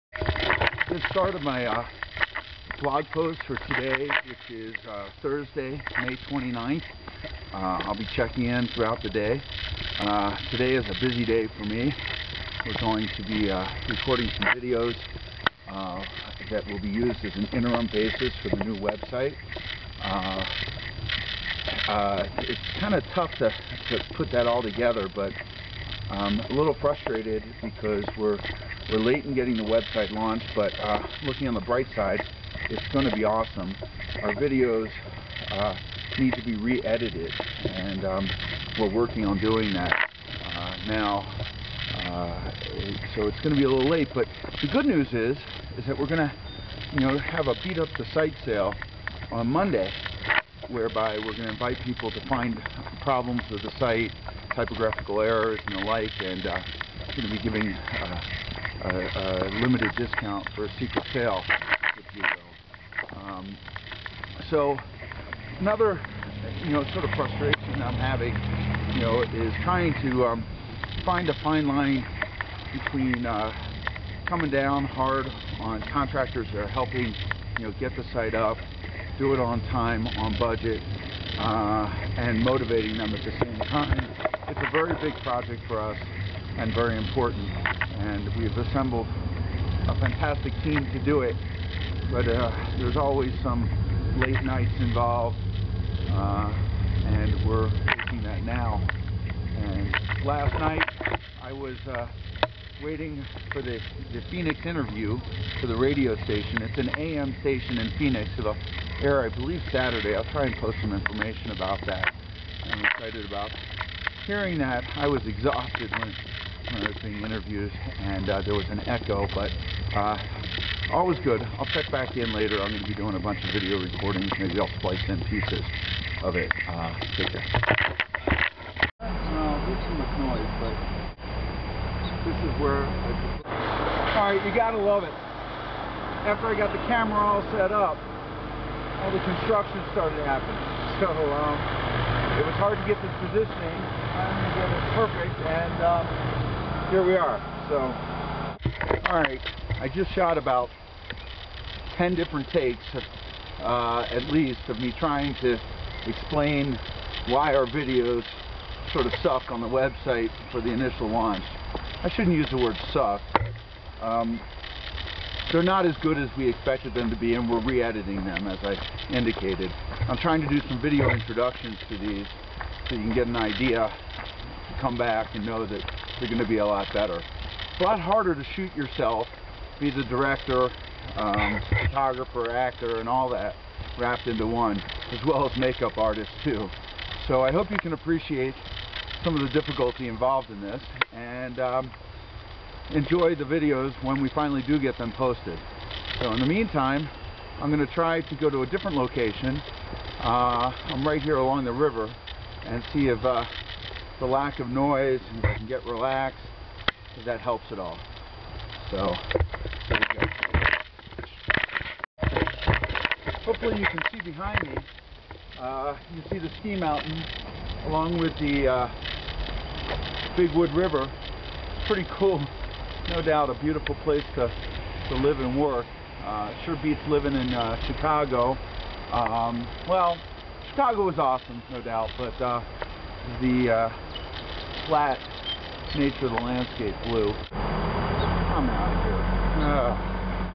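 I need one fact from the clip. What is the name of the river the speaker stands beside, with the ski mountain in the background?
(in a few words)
Big Wood River.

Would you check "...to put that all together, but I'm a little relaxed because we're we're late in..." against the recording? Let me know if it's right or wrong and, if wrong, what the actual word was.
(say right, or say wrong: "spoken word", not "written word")
wrong: "frustrated", not "relaxed".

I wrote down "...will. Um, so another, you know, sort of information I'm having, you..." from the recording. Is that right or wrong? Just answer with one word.
wrong.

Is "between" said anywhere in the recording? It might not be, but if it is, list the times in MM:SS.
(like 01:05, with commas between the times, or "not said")
01:12.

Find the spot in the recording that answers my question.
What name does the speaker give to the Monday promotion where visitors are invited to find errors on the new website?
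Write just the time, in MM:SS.
00:47.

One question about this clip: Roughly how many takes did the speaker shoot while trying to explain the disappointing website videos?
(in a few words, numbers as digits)
10.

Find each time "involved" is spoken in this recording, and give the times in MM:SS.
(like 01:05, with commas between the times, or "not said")
01:34, 03:10.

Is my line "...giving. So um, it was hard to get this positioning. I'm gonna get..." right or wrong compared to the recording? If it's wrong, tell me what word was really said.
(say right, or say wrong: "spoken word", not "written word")
wrong: "happening", not "giving".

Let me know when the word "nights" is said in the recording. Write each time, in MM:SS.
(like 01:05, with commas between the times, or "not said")
01:34, 01:40.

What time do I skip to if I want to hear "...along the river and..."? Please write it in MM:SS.
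03:21.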